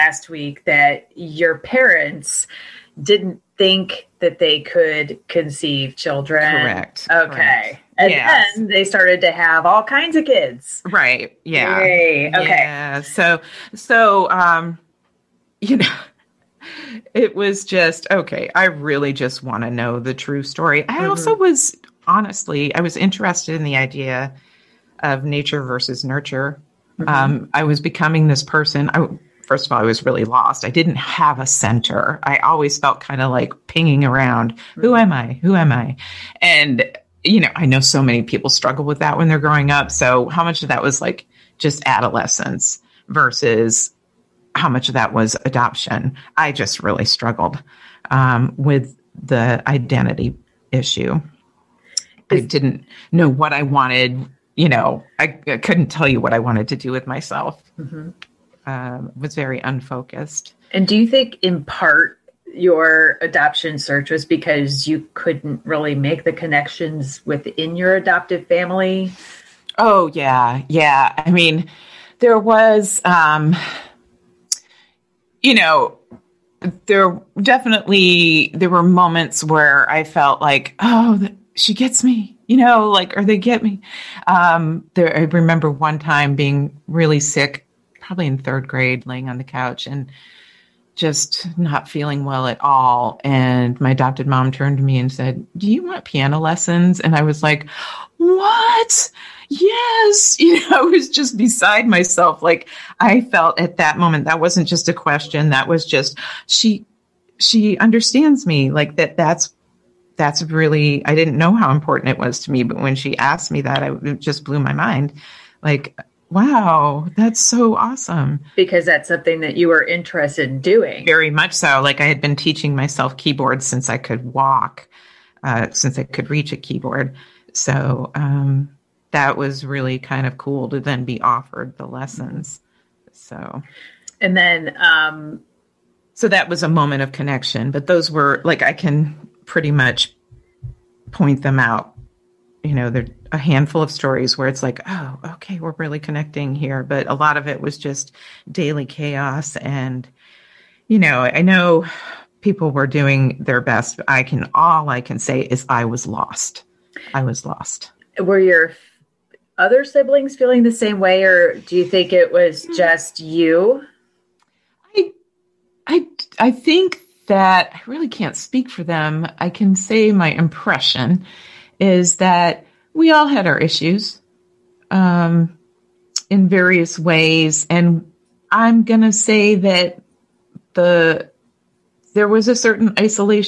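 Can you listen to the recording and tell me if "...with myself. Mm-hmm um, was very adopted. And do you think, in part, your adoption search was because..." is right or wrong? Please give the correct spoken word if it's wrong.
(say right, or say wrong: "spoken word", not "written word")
wrong: "unfocused", not "adopted".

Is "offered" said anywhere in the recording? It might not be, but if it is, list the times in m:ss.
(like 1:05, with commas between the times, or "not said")
2:11.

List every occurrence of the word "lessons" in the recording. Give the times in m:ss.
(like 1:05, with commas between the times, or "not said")
1:36, 2:11.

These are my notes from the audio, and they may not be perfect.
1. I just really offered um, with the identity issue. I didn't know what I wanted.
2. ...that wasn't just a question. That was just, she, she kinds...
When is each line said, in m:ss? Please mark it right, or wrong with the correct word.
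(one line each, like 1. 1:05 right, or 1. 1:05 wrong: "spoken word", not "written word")
1. 0:46 wrong: "struggled", not "offered"
2. 1:44 wrong: "understands", not "kinds".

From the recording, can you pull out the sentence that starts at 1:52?
But when she asked me that, I, it just blew my mind.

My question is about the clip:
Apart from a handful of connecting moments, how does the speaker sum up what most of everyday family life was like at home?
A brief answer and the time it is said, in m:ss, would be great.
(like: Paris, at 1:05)
daily chaos, at 2:28.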